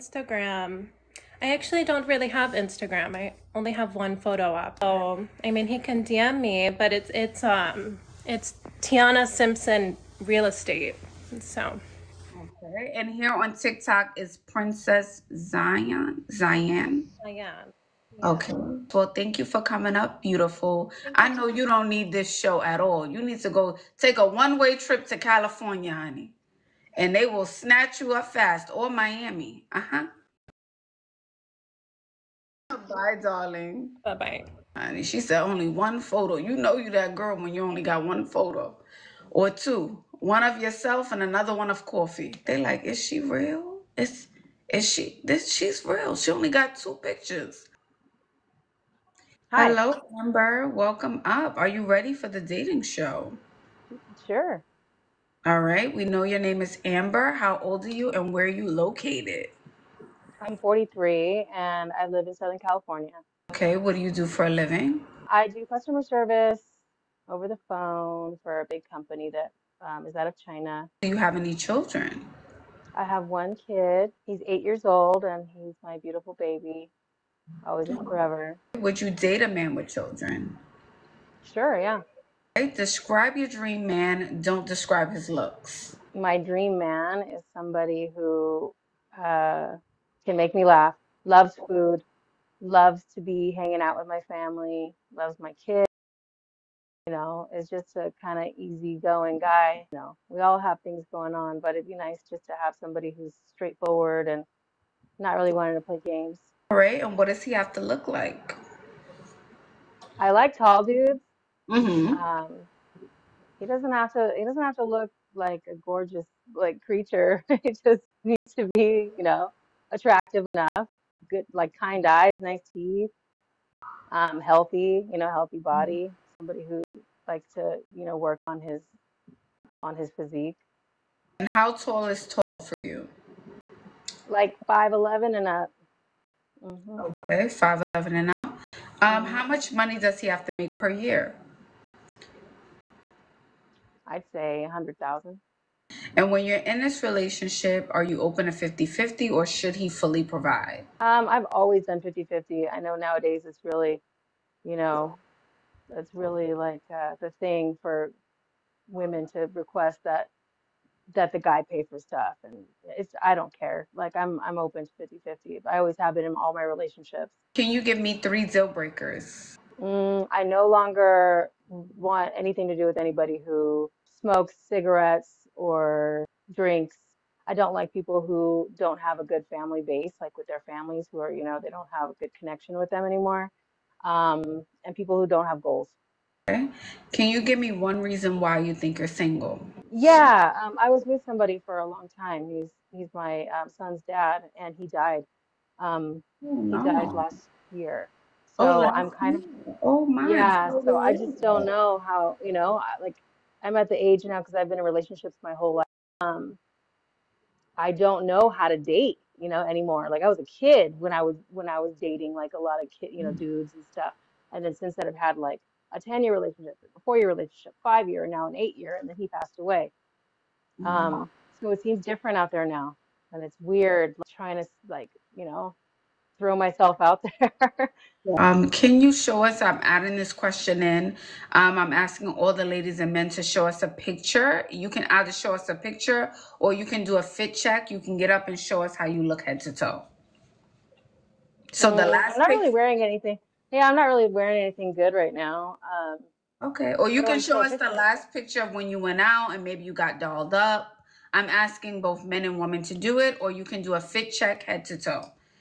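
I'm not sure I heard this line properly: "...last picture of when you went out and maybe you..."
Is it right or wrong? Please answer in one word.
right.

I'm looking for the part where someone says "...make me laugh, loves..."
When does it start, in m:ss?
1:30.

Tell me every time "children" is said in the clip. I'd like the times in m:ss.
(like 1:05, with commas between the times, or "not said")
1:11, 1:19.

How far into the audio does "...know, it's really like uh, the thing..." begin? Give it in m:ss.
2:34.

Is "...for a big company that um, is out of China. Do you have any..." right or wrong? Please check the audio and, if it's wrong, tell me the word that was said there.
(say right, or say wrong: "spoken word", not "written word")
right.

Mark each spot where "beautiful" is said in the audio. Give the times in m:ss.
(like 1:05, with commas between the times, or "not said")
0:20, 1:15.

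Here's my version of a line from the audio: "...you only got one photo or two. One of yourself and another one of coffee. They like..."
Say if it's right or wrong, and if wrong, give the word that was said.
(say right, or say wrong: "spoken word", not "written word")
right.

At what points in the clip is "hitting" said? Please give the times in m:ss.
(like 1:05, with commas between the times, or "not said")
not said.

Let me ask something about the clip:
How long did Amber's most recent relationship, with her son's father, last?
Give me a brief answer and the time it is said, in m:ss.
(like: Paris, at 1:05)
8 years, at 3:38.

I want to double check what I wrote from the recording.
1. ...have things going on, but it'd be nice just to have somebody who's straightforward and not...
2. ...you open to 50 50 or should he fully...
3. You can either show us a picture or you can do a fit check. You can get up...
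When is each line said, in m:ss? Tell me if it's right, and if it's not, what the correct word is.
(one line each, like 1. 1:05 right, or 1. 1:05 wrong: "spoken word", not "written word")
1. 1:40 right
2. 2:28 right
3. 3:54 right.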